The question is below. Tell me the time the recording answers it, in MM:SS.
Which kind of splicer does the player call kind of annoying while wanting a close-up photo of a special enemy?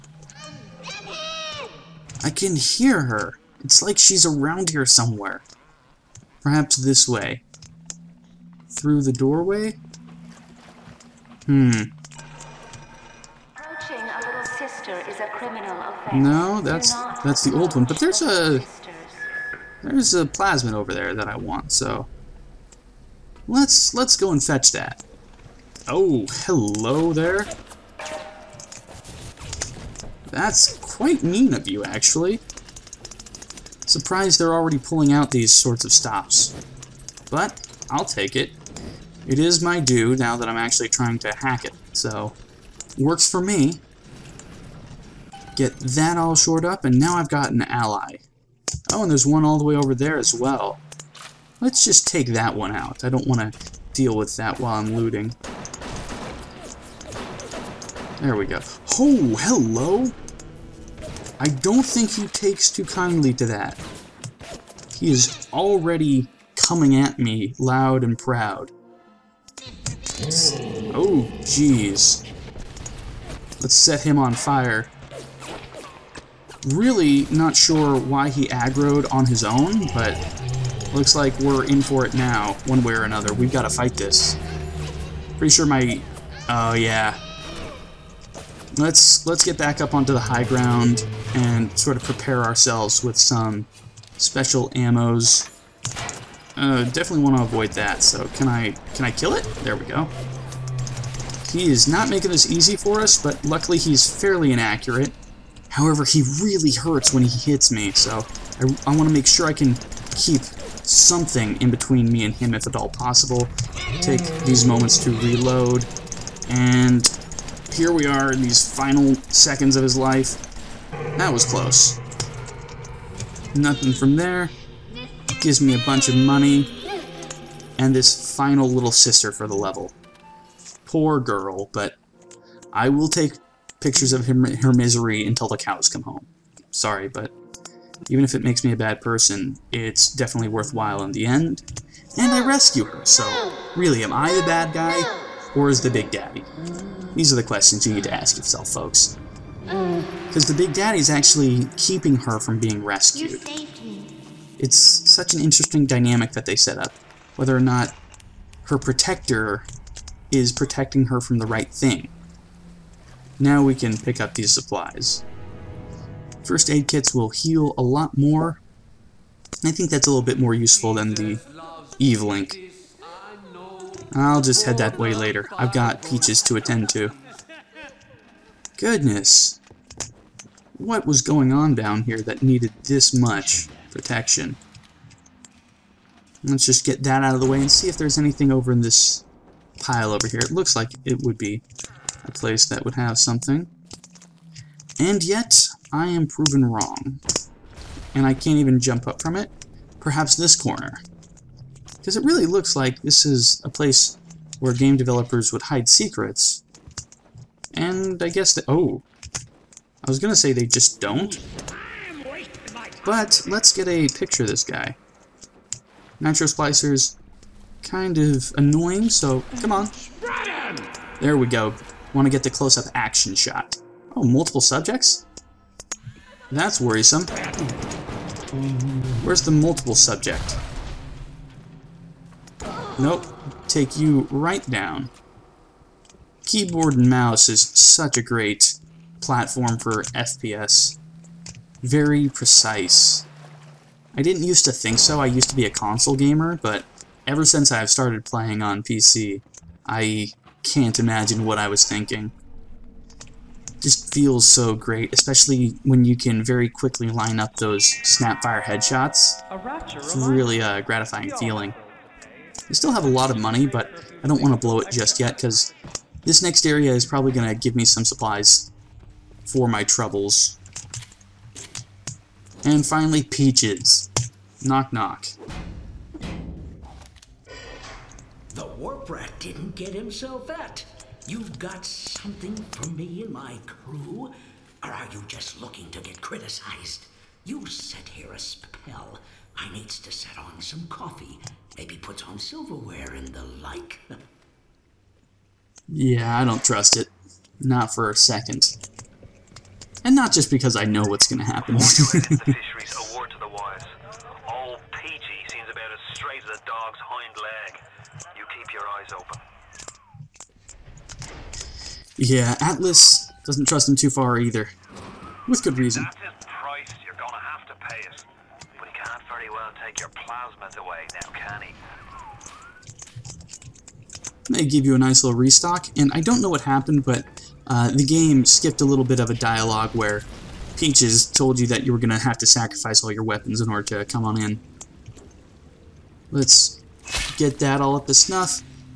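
03:36.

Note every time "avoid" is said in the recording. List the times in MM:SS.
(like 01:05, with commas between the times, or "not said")
01:37.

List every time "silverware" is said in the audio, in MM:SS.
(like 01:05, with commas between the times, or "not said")
04:52.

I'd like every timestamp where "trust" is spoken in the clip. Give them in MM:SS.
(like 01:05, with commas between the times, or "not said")
04:56, 05:13.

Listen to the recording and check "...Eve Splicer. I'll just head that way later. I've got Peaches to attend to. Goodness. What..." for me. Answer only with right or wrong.
wrong.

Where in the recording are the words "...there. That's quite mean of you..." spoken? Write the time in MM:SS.
00:27.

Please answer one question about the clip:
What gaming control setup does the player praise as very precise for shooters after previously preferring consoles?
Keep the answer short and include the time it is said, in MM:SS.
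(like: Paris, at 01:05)
Keyboard and mouse, at 03:56.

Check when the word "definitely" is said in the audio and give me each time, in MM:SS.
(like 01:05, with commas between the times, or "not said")
01:36, 02:20.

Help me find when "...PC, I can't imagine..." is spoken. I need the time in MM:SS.
04:08.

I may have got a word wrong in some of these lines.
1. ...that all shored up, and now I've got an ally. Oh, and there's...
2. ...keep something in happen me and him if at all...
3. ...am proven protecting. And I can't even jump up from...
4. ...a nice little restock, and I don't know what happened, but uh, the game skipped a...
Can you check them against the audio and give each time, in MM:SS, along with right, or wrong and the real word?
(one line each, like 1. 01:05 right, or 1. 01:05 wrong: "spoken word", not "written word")
1. 00:45 right
2. 01:50 wrong: "between", not "happen"
3. 03:16 wrong: "wrong", not "protecting"
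4. 05:24 right.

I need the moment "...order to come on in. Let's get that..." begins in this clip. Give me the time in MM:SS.
05:33.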